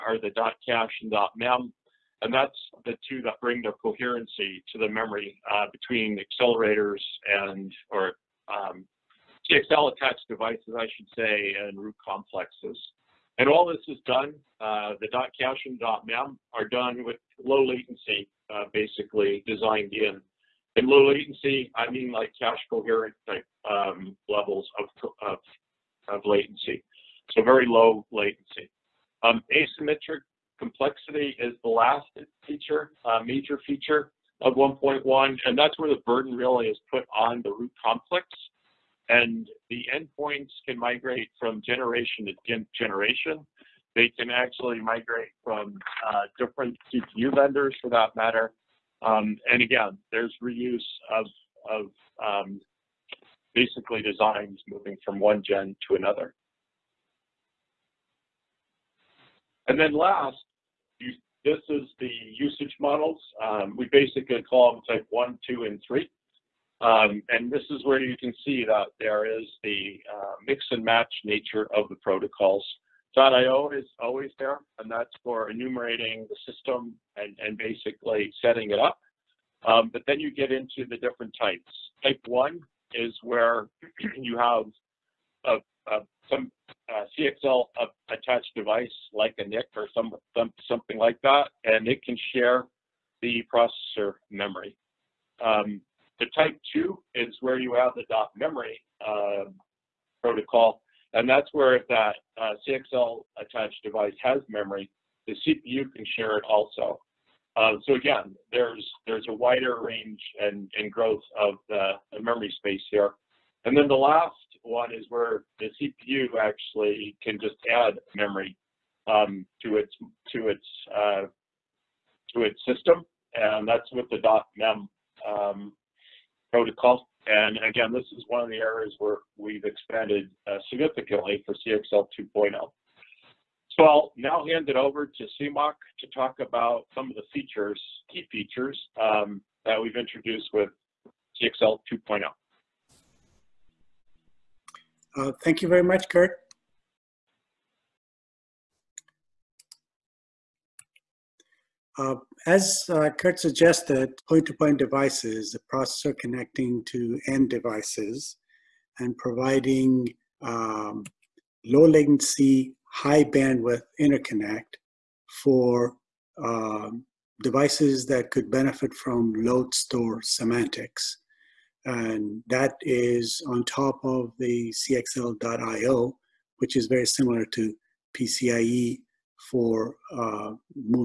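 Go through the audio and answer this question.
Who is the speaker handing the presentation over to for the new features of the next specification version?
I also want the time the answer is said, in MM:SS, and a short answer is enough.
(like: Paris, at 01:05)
Siamak, at 02:15.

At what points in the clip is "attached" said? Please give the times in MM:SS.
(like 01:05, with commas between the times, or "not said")
00:09, 01:28, 01:43.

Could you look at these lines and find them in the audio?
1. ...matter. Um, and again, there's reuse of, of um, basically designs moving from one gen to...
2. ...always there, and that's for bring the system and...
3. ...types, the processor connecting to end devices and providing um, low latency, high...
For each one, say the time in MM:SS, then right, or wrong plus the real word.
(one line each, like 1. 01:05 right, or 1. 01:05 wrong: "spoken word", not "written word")
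1. 00:48 right
2. 01:13 wrong: "enumerating", not "bring"
3. 02:34 wrong: "devices", not "types".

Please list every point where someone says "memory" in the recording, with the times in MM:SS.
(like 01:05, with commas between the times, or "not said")
00:04, 01:34, 01:38, 01:44, 01:52, 01:58.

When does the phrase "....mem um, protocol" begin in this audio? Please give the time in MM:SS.
02:04.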